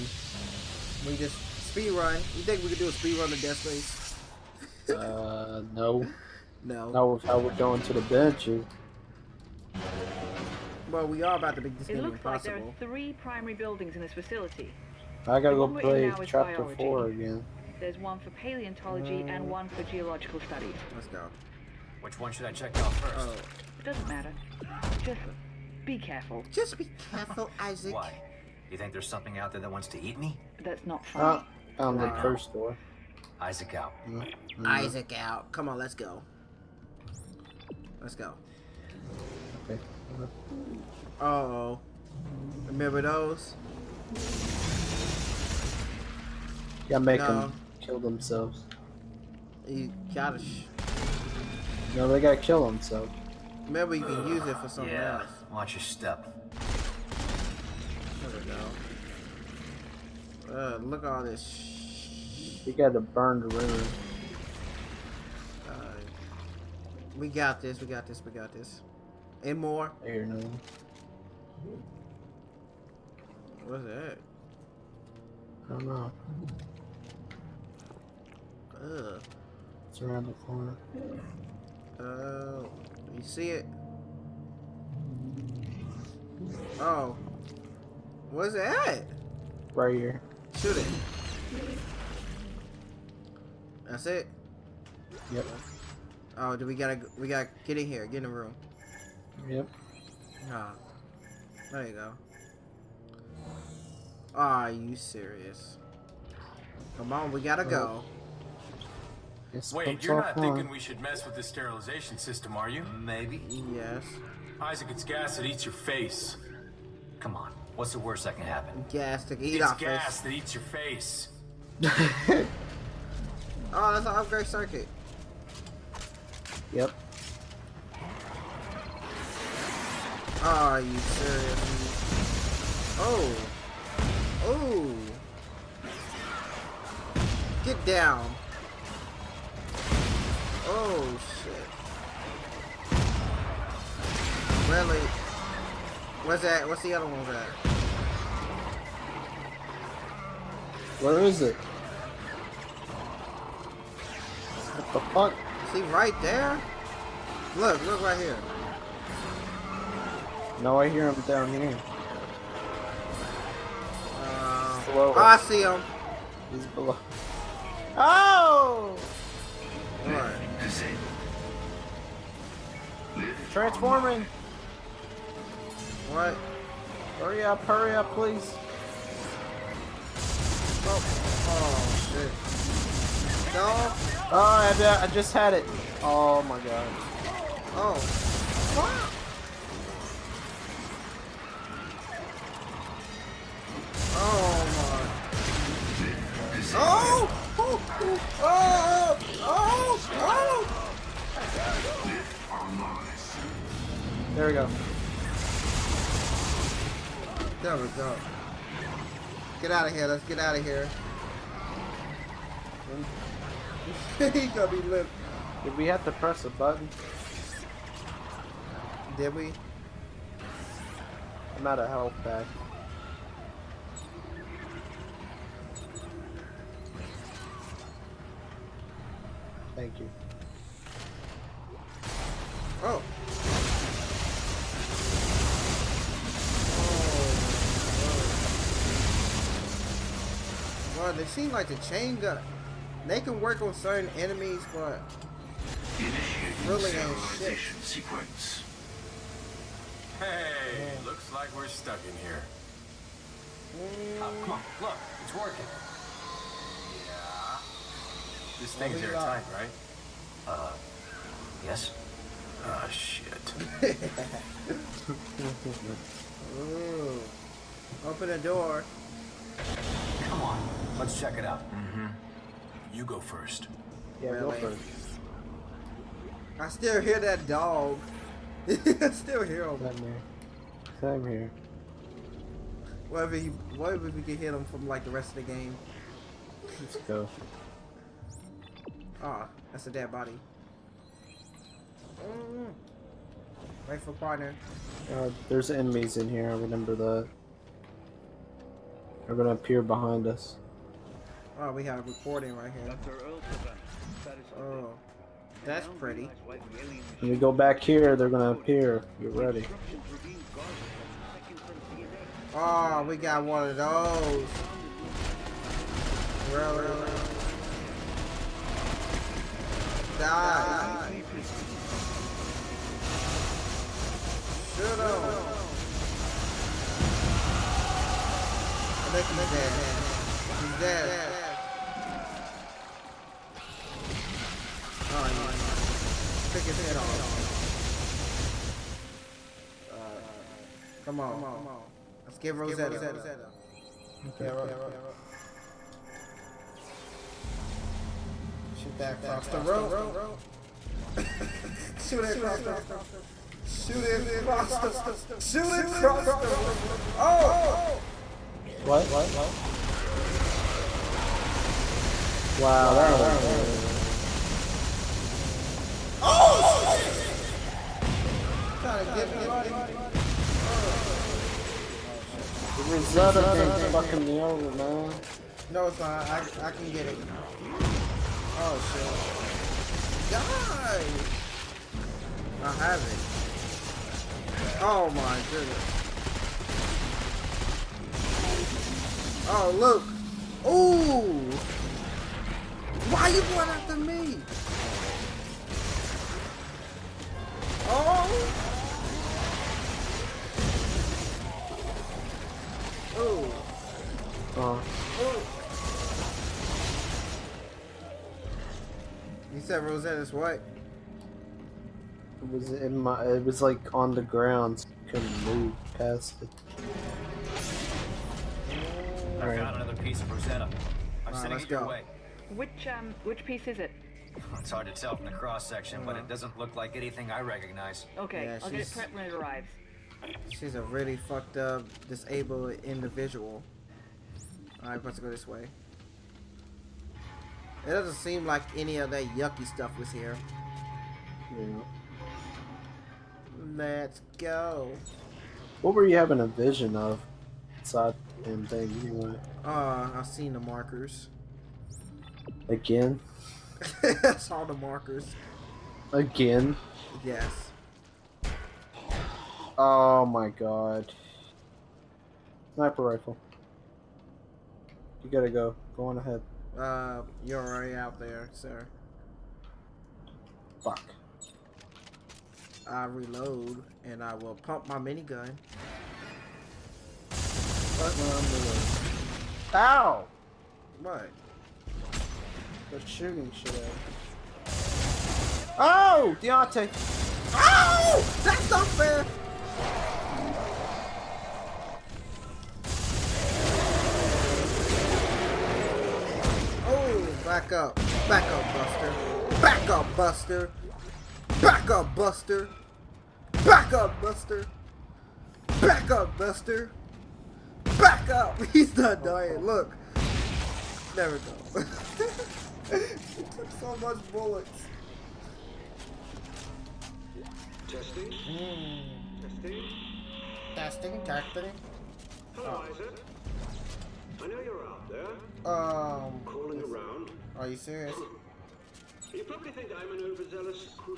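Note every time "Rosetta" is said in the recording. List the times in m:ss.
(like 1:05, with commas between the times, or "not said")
5:42, 6:12, 6:49.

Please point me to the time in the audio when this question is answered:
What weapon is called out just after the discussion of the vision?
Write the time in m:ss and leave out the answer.
7:42.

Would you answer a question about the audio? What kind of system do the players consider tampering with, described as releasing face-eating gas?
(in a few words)
Sterilization system.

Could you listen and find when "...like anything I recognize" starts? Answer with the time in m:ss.
7:06.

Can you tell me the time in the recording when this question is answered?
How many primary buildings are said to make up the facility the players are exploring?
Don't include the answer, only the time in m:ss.
0:12.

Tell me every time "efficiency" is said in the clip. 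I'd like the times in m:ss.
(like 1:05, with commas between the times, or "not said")
not said.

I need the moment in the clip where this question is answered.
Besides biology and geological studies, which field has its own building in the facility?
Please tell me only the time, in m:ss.
0:18.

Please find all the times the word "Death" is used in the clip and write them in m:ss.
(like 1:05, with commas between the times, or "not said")
0:03.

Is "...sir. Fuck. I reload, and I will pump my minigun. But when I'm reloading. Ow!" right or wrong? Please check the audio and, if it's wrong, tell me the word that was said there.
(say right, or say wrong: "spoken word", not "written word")
right.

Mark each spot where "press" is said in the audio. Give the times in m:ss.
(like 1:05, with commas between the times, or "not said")
3:36.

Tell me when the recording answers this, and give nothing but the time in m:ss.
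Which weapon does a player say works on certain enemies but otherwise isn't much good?
4:01.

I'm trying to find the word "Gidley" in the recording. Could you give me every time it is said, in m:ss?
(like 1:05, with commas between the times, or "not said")
not said.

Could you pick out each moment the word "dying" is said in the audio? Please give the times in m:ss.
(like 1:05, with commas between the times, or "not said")
8:29.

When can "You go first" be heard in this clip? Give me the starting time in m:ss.
4:32.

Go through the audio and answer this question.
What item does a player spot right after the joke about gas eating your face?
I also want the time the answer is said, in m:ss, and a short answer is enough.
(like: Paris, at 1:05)
Upgrade circuit, at 2:04.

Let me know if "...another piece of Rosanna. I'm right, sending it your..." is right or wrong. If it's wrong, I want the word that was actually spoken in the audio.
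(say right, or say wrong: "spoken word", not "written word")
right.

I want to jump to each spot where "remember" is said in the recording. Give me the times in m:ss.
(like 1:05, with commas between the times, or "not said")
0:42, 4:56.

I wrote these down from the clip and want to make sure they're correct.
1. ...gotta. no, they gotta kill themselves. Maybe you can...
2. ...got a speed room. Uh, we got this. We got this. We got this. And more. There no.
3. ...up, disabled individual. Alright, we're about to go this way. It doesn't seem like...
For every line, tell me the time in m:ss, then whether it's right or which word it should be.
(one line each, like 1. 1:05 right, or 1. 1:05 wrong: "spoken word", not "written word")
1. 0:50 right
2. 1:02 wrong: "burned", not "speed"
3. 7:11 right.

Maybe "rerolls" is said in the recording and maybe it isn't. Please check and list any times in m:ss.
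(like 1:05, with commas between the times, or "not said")
not said.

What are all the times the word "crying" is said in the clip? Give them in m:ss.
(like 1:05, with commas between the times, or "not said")
not said.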